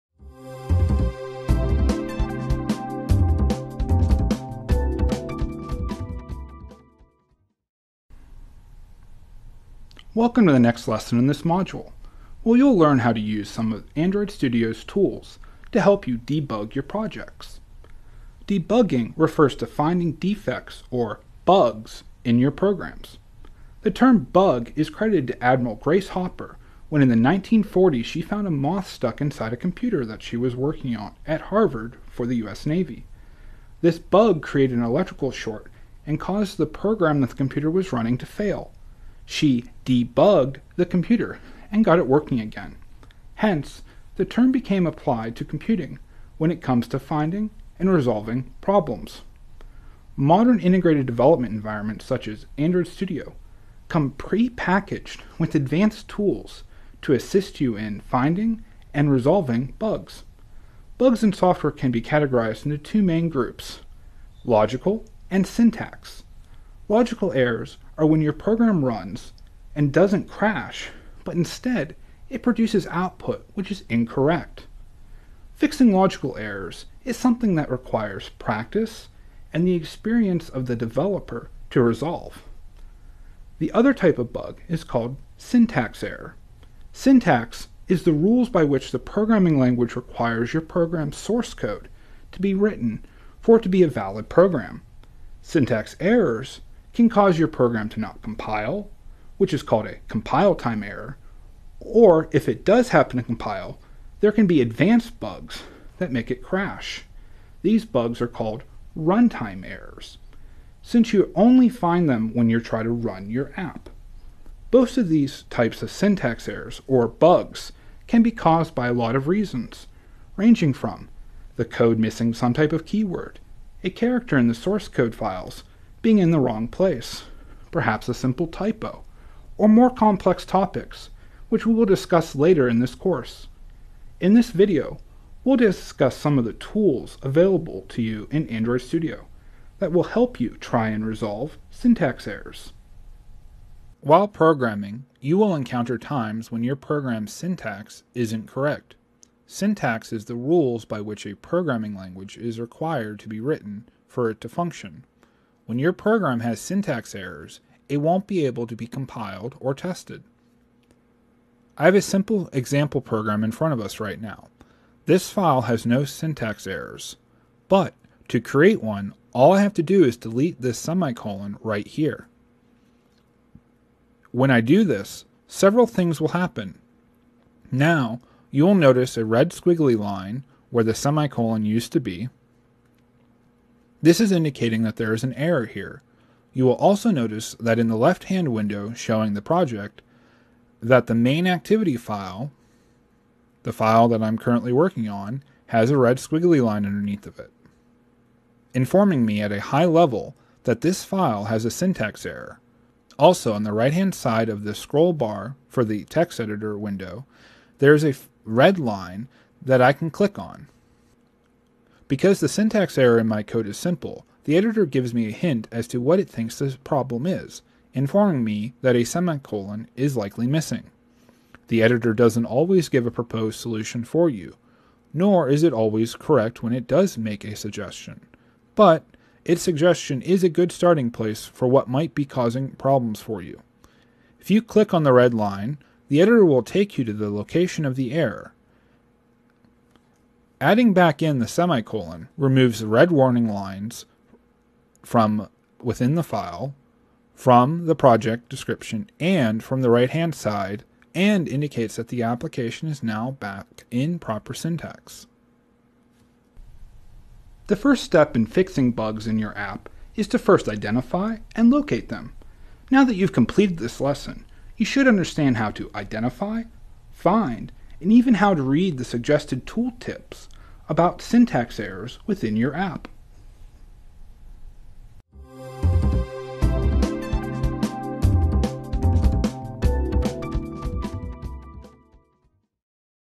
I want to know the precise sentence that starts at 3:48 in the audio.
But its suggestion is a good starting place for what might be causing problems for you.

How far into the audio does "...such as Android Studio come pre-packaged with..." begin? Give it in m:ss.
0:52.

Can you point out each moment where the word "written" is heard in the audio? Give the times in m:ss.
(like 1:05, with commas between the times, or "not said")
1:32, 2:33.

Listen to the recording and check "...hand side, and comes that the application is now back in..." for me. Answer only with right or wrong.
wrong.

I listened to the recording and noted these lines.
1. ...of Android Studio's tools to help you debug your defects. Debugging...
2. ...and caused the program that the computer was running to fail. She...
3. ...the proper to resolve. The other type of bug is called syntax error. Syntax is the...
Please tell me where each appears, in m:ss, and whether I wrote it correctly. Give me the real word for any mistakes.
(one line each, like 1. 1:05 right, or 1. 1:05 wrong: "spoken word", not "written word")
1. 0:13 wrong: "projects", not "defects"
2. 0:36 right
3. 1:20 wrong: "developer", not "proper".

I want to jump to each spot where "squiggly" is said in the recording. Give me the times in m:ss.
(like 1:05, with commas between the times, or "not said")
2:59, 3:16.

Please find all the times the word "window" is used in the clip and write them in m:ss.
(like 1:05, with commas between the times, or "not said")
3:08, 3:26.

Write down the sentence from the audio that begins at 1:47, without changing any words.
These bugs are called runtime errors, since you only find them when you try to run your app.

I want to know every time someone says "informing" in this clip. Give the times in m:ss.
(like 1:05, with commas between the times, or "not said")
3:18, 3:37.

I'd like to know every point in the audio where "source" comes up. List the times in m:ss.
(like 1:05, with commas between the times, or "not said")
1:31, 2:04.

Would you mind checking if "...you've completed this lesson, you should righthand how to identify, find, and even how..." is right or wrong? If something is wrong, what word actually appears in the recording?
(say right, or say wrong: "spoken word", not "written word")
wrong: "understand", not "righthand".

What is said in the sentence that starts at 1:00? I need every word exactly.
Bugs in software can be categorized into two main groups, logical and syntax.